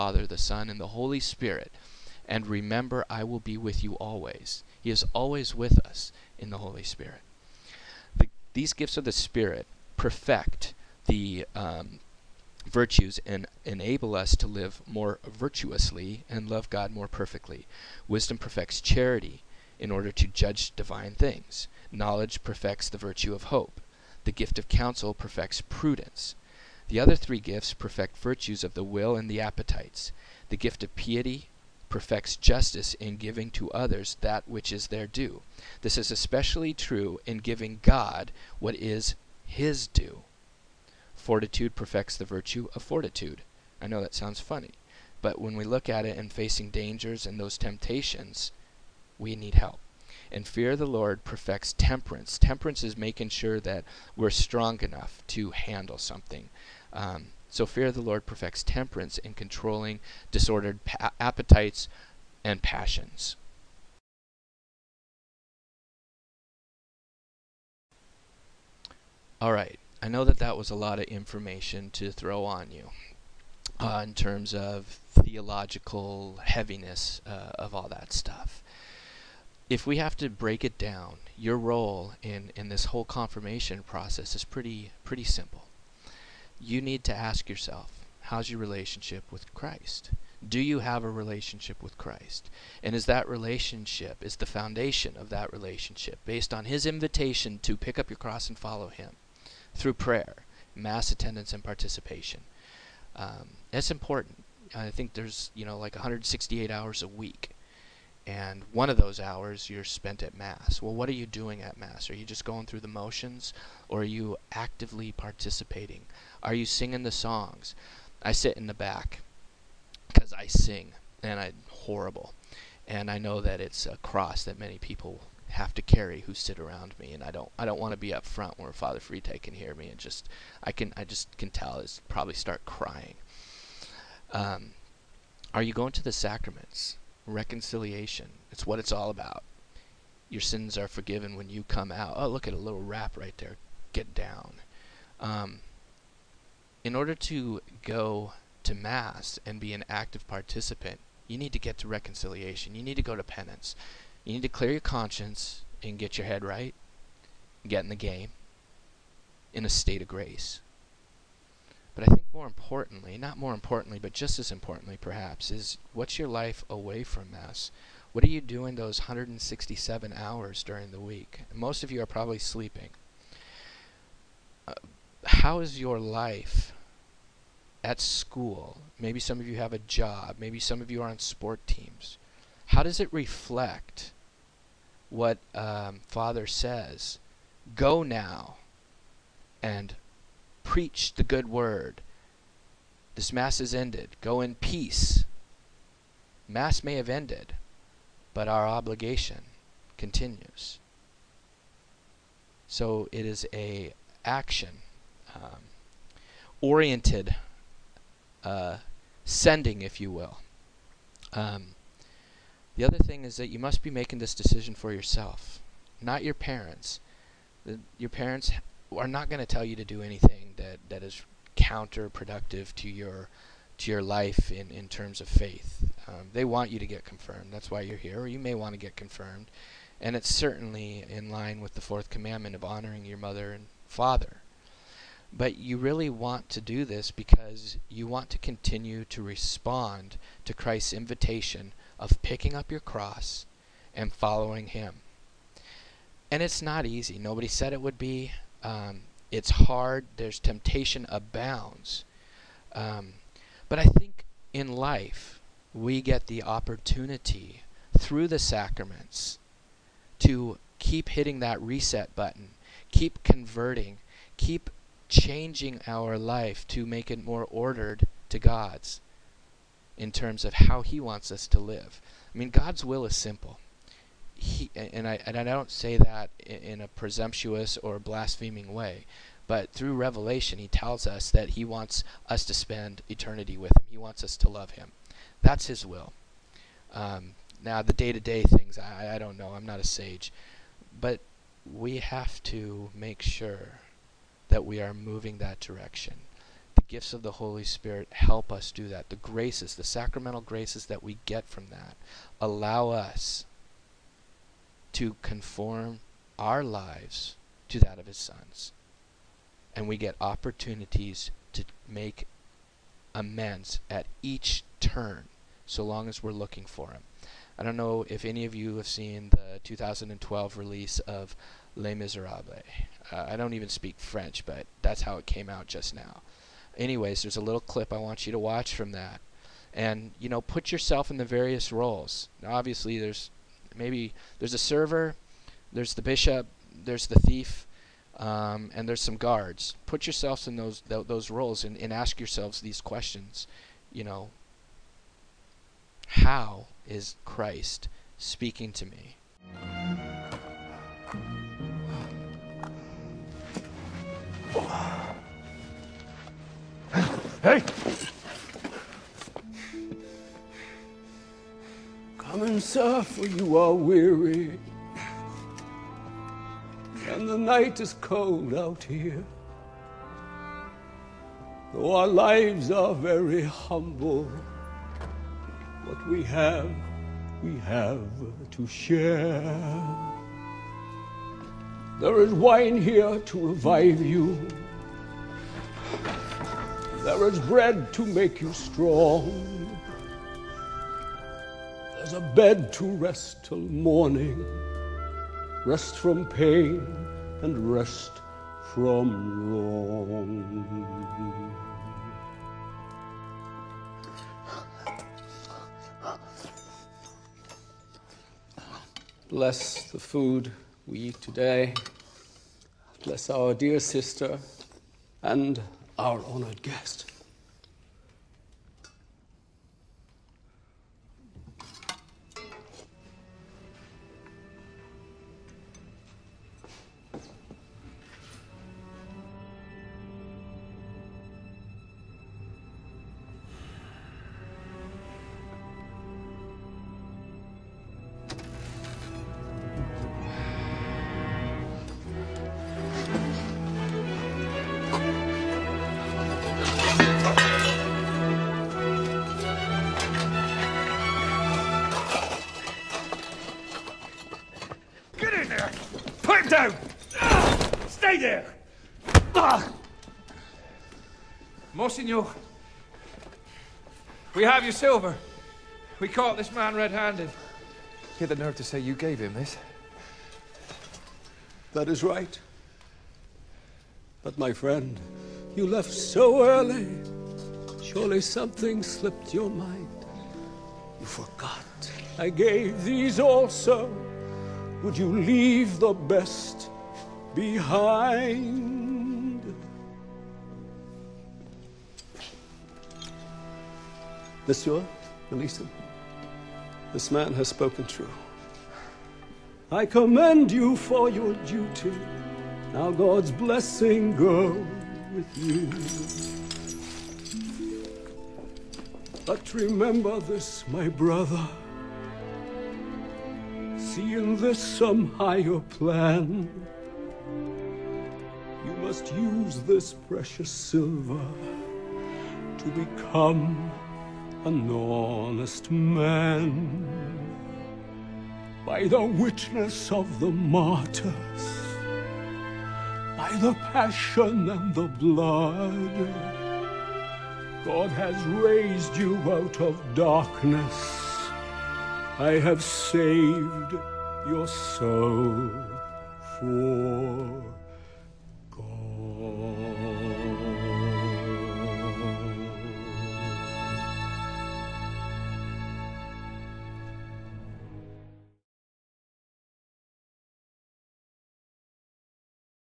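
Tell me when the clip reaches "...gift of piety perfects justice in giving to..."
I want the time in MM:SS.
00:30.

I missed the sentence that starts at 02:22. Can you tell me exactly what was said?
Oh, look at a little rap right there.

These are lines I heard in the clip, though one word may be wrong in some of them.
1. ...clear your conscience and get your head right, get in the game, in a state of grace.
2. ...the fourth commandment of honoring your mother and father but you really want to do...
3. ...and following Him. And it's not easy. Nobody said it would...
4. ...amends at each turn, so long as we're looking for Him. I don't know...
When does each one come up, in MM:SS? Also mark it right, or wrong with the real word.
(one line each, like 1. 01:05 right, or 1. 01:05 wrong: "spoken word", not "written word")
1. 02:34 right
2. 03:51 right
3. 04:03 right
4. 05:13 right.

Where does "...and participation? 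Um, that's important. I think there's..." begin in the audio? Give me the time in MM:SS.
01:41.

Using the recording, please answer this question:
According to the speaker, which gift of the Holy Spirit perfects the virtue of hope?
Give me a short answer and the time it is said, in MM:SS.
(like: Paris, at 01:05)
Knowledge, at 00:21.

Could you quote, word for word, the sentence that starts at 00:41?
Fortitude perfects the virtue of fortitude.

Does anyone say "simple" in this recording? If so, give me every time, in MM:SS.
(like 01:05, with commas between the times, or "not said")
01:25, 04:33.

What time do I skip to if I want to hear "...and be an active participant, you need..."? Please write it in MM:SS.
02:29.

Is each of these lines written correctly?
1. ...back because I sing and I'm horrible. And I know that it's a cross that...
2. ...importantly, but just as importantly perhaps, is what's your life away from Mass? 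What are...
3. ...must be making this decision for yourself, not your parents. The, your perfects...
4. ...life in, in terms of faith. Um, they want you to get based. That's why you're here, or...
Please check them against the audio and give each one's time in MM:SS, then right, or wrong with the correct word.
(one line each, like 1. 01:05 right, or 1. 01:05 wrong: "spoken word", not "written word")
1. 01:58 right
2. 02:43 right
3. 03:33 wrong: "parents", not "perfects"
4. 03:44 wrong: "confirmed", not "based".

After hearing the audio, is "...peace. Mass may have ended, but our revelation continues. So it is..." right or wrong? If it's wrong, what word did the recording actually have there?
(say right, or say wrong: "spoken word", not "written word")
wrong: "obligation", not "revelation".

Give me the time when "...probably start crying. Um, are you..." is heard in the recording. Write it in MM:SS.
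02:12.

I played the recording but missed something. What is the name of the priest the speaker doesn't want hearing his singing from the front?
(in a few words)
Father Frite.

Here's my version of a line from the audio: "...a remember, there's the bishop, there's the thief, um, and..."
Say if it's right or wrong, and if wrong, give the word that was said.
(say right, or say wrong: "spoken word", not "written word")
wrong: "server", not "remember".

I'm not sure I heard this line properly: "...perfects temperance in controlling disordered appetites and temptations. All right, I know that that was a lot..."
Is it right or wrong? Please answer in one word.
wrong.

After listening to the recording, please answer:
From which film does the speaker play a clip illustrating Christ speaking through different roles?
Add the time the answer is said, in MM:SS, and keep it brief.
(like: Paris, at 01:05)
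Les Miserables, at 05:21.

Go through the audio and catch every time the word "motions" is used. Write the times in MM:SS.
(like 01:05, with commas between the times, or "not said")
01:52.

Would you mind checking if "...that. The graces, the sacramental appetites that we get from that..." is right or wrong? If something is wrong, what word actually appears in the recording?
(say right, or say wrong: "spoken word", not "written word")
wrong: "graces", not "appetites".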